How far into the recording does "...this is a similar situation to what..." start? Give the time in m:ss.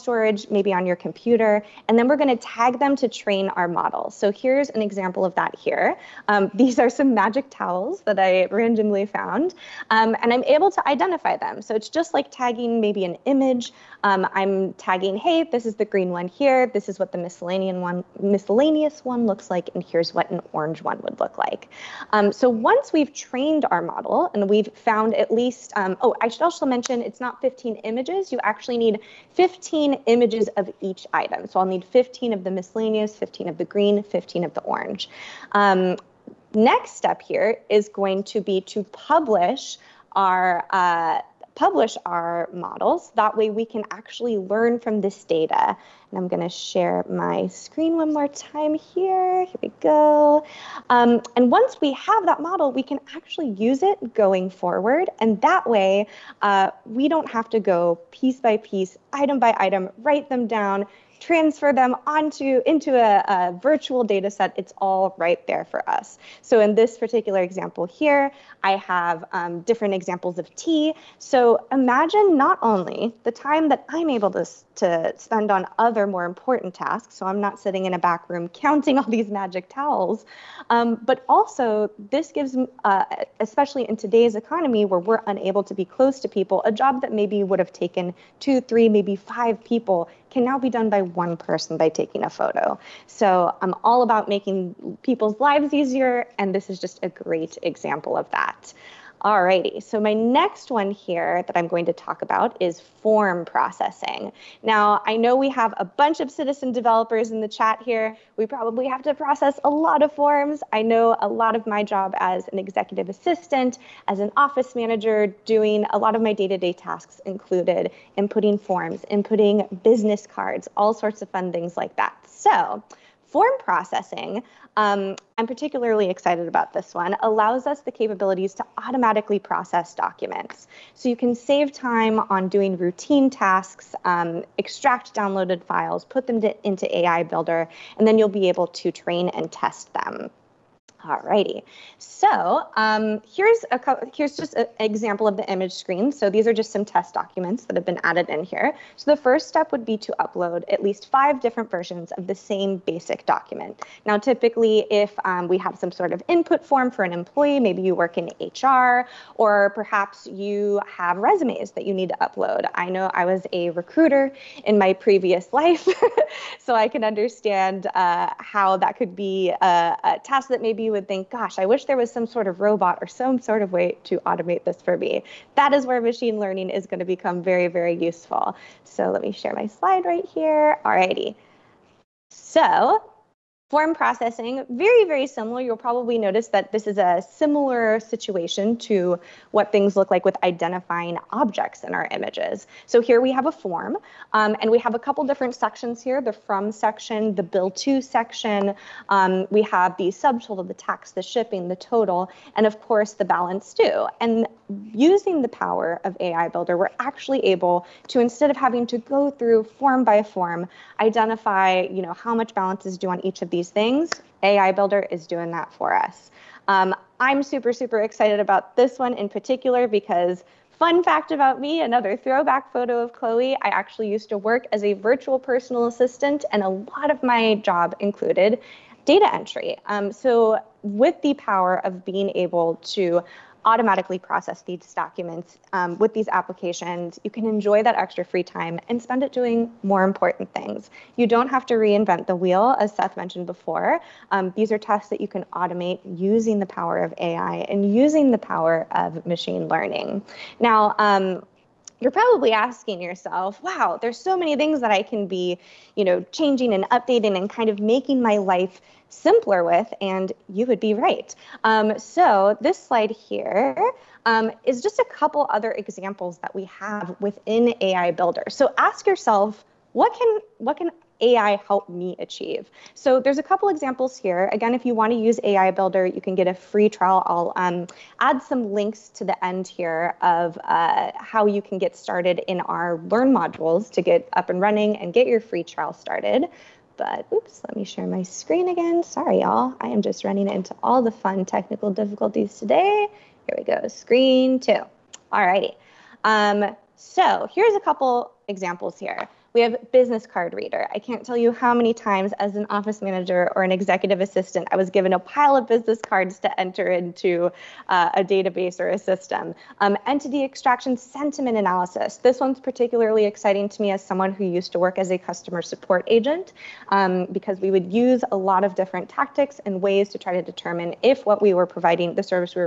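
3:06.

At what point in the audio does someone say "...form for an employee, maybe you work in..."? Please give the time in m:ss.
2:36.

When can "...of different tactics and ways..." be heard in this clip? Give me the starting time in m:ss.
5:18.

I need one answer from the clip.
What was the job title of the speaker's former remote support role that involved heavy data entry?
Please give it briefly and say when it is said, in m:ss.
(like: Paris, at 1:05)
Virtual personal assistant, at 3:44.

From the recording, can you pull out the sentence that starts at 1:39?
Alrighty, so my next one here that I'm going to talk about is form processing.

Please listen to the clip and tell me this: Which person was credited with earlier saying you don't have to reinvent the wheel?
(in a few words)
Seth.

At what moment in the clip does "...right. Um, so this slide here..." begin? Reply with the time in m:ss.
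4:20.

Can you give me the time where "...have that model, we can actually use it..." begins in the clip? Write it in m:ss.
0:51.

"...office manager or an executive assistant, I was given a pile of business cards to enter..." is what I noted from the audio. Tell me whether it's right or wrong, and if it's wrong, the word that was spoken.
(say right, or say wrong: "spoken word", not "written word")
right.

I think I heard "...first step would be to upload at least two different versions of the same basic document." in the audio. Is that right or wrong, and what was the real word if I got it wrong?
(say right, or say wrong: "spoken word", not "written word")
wrong: "five", not "two".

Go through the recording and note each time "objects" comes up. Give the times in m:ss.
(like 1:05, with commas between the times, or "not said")
3:11.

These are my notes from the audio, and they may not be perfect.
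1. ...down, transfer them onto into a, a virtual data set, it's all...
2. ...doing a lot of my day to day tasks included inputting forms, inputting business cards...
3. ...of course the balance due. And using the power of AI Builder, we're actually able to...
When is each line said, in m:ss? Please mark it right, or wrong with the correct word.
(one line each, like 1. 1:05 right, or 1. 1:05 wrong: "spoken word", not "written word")
1. 1:00 right
2. 1:55 right
3. 3:22 right.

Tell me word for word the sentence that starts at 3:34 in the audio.
AI Builder is doing that for us.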